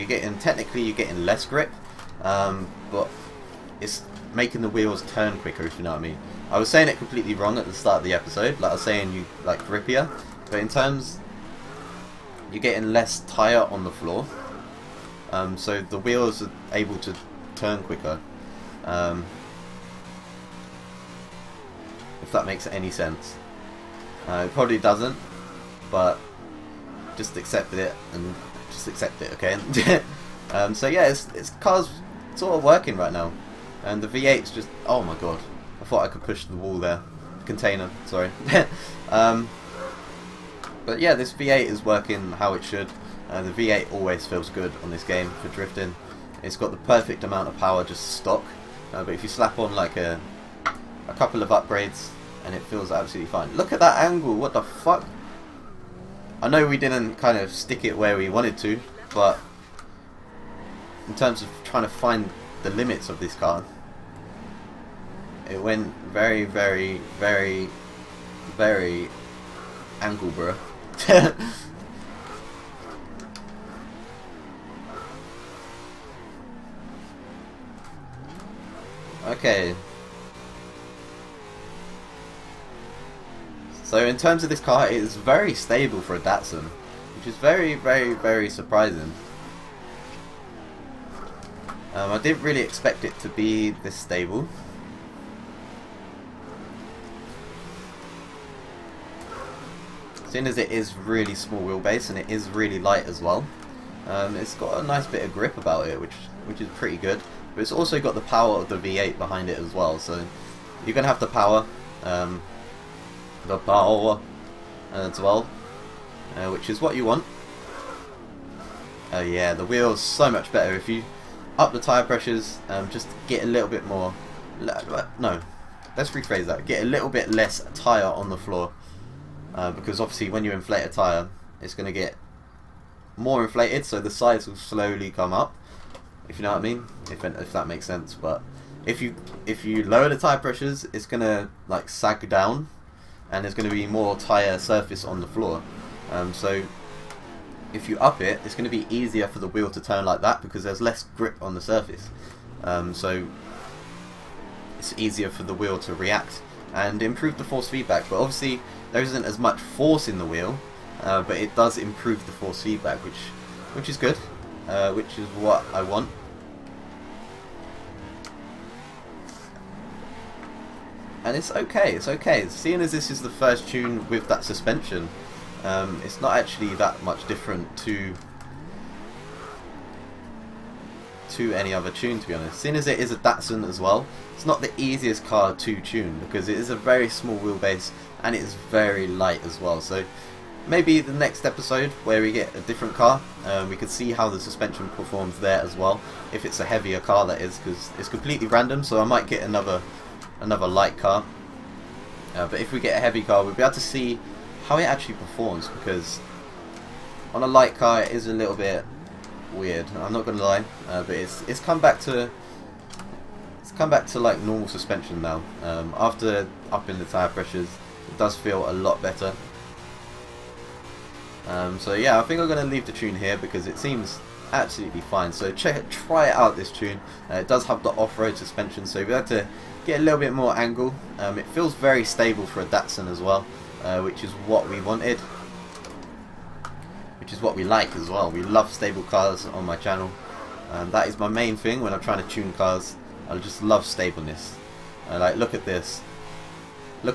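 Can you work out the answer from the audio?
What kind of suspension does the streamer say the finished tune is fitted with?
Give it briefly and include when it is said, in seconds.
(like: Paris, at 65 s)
off-road suspension, at 227 s.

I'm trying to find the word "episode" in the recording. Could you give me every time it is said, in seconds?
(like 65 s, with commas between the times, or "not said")
8 s, 191 s.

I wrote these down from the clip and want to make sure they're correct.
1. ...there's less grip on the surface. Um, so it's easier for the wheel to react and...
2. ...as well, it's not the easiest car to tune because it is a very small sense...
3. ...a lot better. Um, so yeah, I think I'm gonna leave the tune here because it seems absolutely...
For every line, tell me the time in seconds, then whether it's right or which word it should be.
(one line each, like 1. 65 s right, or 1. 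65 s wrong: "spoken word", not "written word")
1. 150 s right
2. 183 s wrong: "wheelbase", not "sense"
3. 218 s right.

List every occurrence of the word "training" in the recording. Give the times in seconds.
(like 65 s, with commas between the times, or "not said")
not said.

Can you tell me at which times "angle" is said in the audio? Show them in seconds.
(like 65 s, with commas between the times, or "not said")
54 s, 70 s, 230 s.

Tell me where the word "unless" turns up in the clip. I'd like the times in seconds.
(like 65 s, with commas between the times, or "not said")
not said.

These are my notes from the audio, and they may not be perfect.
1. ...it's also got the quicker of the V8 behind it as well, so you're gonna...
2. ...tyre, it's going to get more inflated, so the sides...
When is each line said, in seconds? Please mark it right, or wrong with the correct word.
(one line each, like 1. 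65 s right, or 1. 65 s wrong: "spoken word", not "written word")
1. 107 s wrong: "power", not "quicker"
2. 130 s right.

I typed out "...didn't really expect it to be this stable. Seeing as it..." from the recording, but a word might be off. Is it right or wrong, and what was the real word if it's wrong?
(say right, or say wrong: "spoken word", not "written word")
right.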